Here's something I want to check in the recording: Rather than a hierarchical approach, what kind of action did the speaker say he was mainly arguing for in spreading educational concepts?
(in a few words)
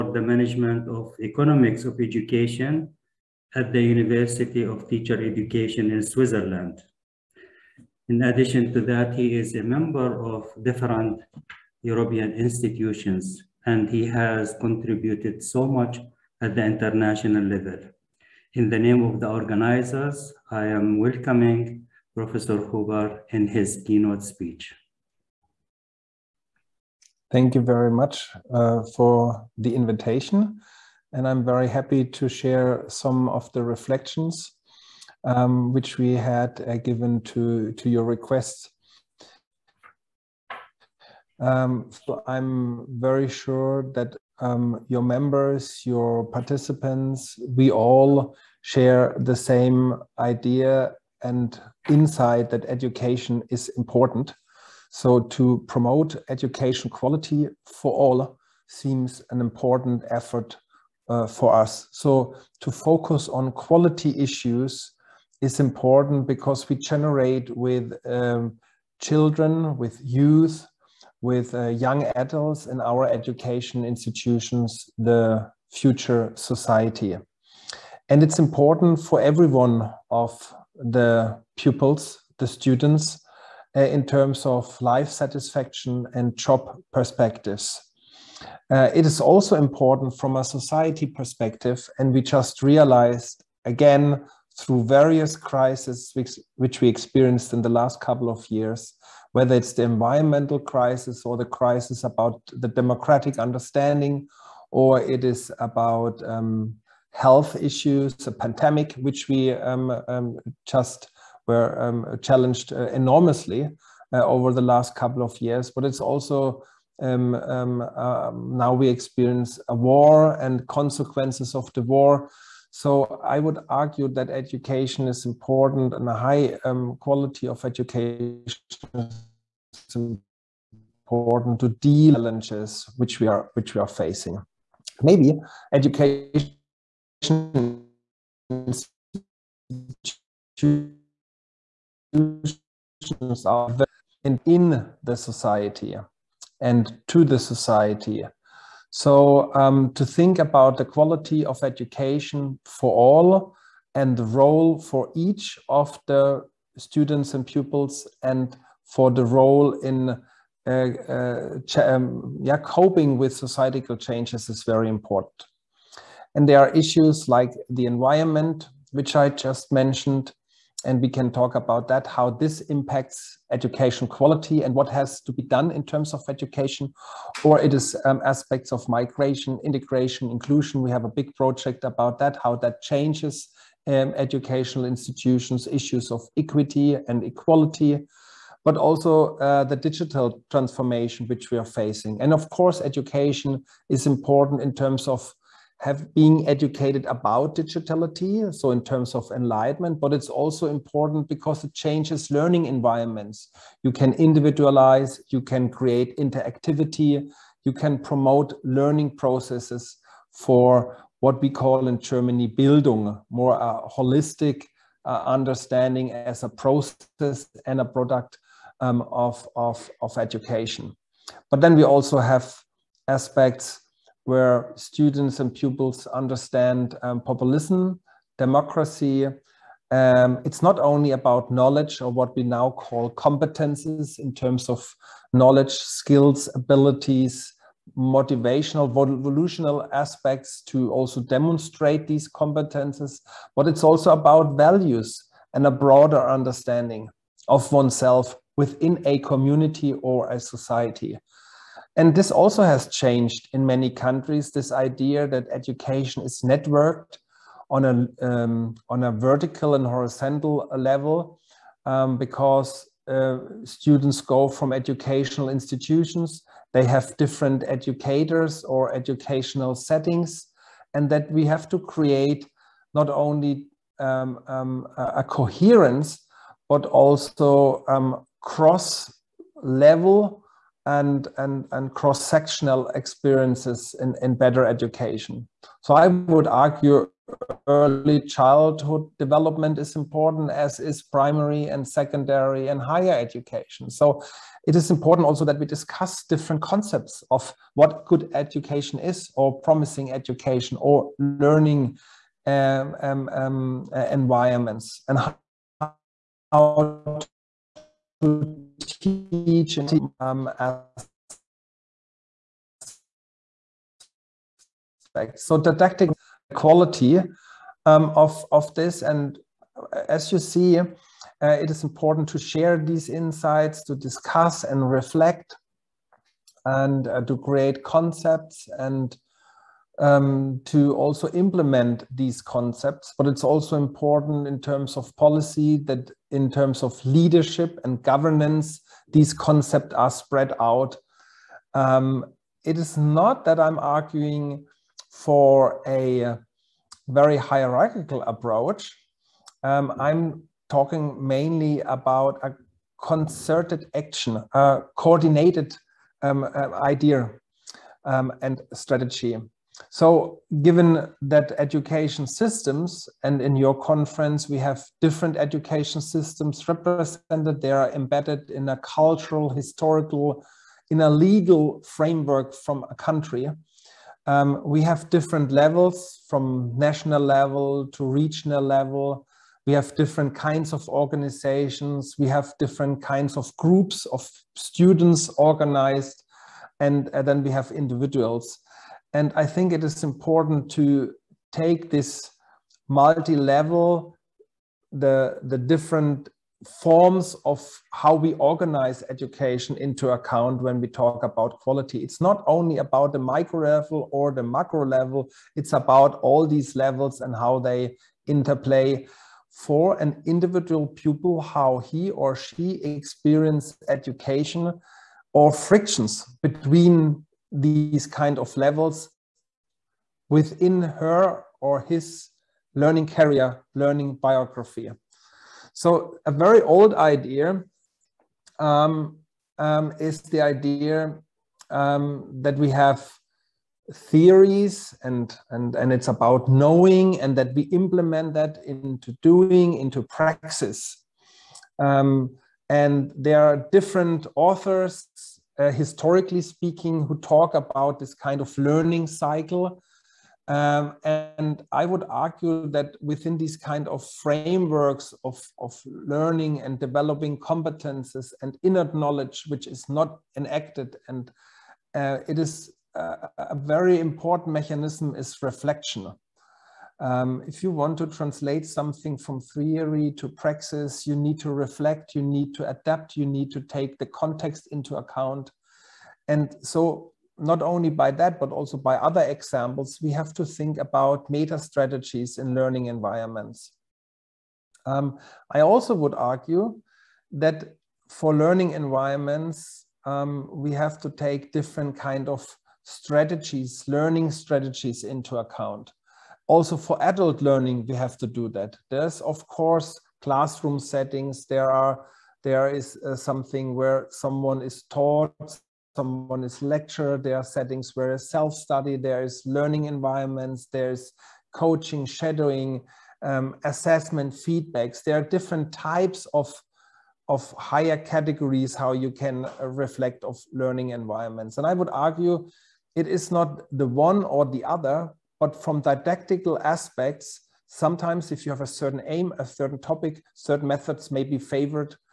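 concerted action.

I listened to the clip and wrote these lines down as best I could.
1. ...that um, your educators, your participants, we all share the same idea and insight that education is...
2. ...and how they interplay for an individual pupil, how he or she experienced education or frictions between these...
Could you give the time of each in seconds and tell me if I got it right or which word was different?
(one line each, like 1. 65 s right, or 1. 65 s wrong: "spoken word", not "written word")
1. 43 s wrong: "members", not "educators"
2. 407 s right.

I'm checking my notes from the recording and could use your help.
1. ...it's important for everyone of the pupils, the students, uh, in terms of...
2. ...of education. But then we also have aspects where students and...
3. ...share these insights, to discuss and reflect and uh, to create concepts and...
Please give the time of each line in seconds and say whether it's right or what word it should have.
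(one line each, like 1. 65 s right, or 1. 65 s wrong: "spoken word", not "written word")
1. 78 s right
2. 220 s right
3. 322 s right.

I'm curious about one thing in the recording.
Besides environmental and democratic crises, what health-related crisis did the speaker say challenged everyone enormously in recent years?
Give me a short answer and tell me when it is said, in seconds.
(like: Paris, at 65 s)
a pandemic, at 108 s.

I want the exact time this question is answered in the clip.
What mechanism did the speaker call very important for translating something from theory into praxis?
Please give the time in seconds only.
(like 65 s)
465 s.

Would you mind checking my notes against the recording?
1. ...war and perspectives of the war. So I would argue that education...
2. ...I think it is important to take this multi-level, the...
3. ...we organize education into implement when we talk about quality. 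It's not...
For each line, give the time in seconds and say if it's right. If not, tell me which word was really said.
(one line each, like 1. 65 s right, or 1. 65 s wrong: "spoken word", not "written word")
1. 119 s wrong: "consequences", not "perspectives"
2. 389 s right
3. 398 s wrong: "account", not "implement".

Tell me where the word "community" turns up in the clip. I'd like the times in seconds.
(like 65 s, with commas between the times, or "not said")
249 s.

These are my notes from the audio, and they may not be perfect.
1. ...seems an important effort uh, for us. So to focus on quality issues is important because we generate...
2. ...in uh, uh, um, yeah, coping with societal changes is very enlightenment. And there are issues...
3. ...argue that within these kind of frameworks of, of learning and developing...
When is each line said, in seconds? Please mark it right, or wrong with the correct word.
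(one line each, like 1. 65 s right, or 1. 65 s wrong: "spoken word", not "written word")
1. 58 s right
2. 159 s wrong: "important", not "enlightenment"
3. 452 s right.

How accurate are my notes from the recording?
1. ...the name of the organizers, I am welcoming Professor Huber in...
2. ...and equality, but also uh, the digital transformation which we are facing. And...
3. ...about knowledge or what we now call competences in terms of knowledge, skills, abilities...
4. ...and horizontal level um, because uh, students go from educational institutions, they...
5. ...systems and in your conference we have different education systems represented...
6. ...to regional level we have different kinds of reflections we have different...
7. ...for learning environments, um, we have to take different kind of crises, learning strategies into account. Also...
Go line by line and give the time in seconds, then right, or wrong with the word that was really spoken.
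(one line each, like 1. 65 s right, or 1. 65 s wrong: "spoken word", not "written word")
1. 18 s right
2. 187 s right
3. 231 s right
4. 259 s right
5. 362 s right
6. 377 s wrong: "organizations", not "reflections"
7. 488 s wrong: "strategies", not "crises".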